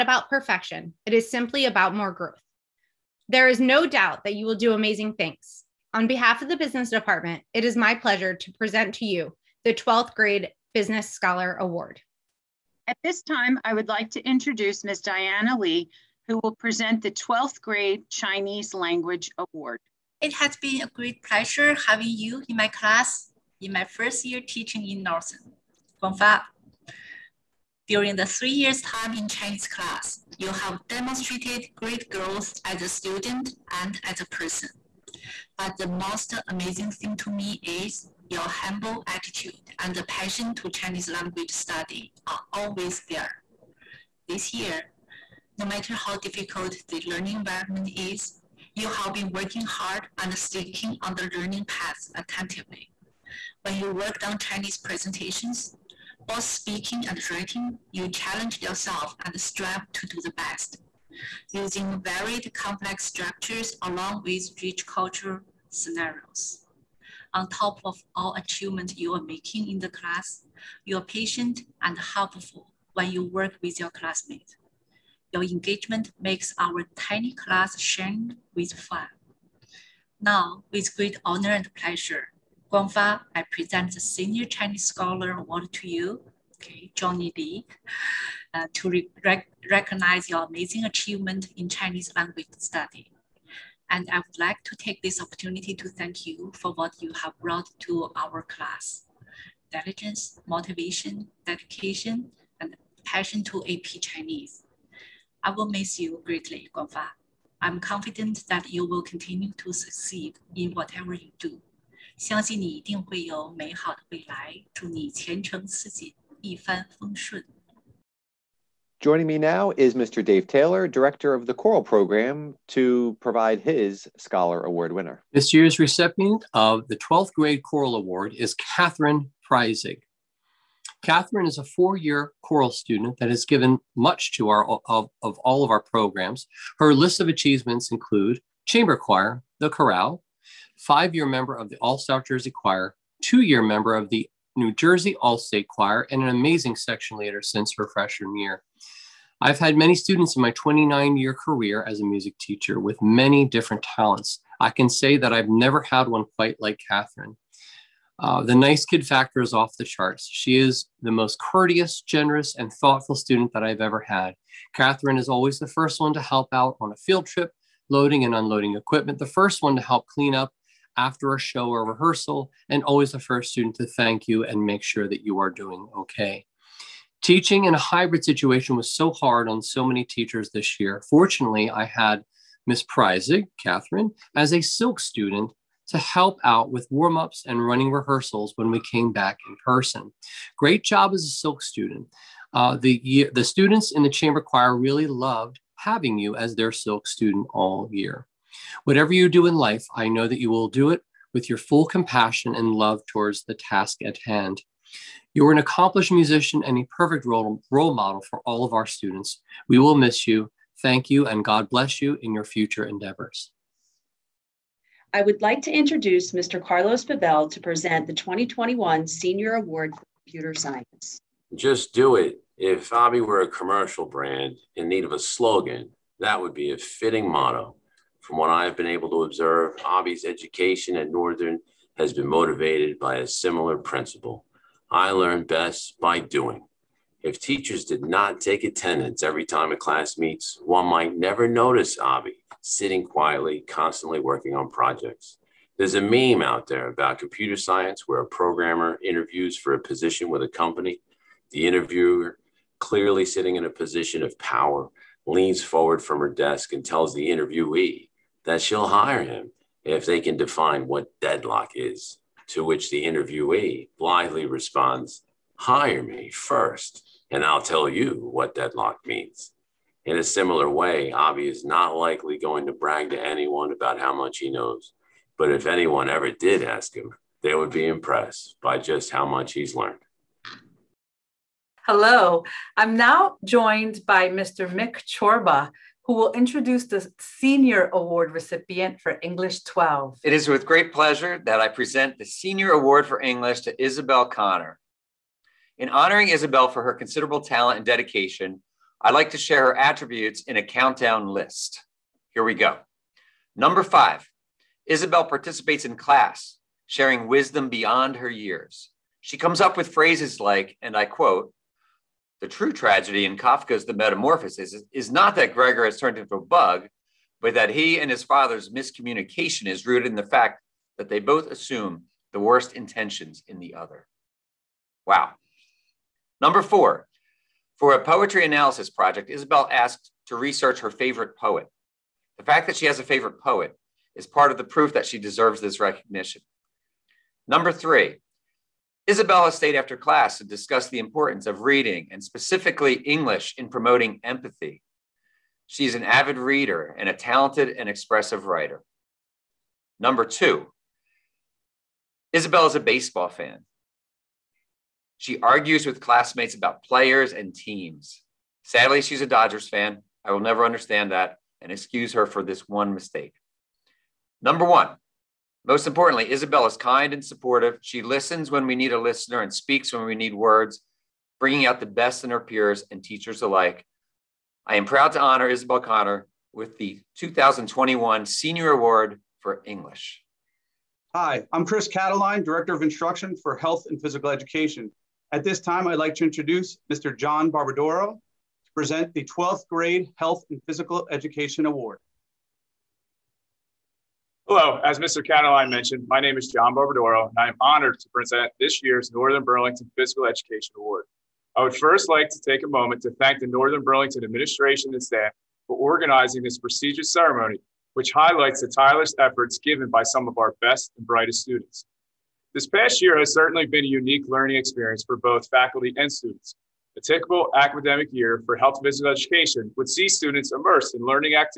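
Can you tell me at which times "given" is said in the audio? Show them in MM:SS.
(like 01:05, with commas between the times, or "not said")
02:13, 06:49.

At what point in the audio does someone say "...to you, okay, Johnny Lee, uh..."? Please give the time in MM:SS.
01:25.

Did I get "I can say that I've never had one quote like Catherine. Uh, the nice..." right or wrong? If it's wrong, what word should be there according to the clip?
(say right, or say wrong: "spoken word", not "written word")
wrong: "quite", not "quote".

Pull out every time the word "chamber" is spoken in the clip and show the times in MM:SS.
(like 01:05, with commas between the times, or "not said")
02:18, 03:14.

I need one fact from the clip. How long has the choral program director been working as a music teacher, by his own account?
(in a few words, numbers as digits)
29 years.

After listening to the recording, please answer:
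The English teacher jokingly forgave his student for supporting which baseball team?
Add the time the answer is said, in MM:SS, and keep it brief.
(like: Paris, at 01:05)
Dodgers, at 05:59.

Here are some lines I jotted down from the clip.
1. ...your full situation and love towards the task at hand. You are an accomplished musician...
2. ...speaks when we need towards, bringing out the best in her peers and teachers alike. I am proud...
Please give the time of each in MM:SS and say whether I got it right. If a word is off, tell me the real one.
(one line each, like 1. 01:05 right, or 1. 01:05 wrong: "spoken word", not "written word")
1. 03:21 wrong: "compassion", not "situation"
2. 06:09 wrong: "words", not "towards".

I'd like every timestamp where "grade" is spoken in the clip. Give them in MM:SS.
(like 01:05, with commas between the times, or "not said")
00:10, 00:17, 02:07, 06:29.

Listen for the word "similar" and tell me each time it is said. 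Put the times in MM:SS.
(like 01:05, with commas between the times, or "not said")
03:53, 04:30.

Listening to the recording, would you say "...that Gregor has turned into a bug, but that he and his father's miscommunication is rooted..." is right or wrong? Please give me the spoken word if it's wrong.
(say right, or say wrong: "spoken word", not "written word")
right.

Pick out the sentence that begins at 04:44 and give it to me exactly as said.
Mick Chorba, who will introduce the Senior Award recipient for English 12.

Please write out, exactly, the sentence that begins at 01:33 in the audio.
And I would like to take this opportunity to thank you for what you have brought to our class.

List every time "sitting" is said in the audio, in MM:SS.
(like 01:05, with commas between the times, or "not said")
04:02, 04:13.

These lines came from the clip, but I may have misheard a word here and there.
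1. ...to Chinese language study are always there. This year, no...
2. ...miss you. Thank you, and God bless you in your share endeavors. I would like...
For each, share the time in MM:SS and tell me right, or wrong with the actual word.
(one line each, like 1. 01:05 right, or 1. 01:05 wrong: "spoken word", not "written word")
1. 00:40 right
2. 03:29 wrong: "future", not "share".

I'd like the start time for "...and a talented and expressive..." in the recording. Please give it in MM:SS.
05:46.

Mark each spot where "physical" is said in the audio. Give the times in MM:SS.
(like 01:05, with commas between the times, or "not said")
06:24, 06:30, 06:39, 06:58.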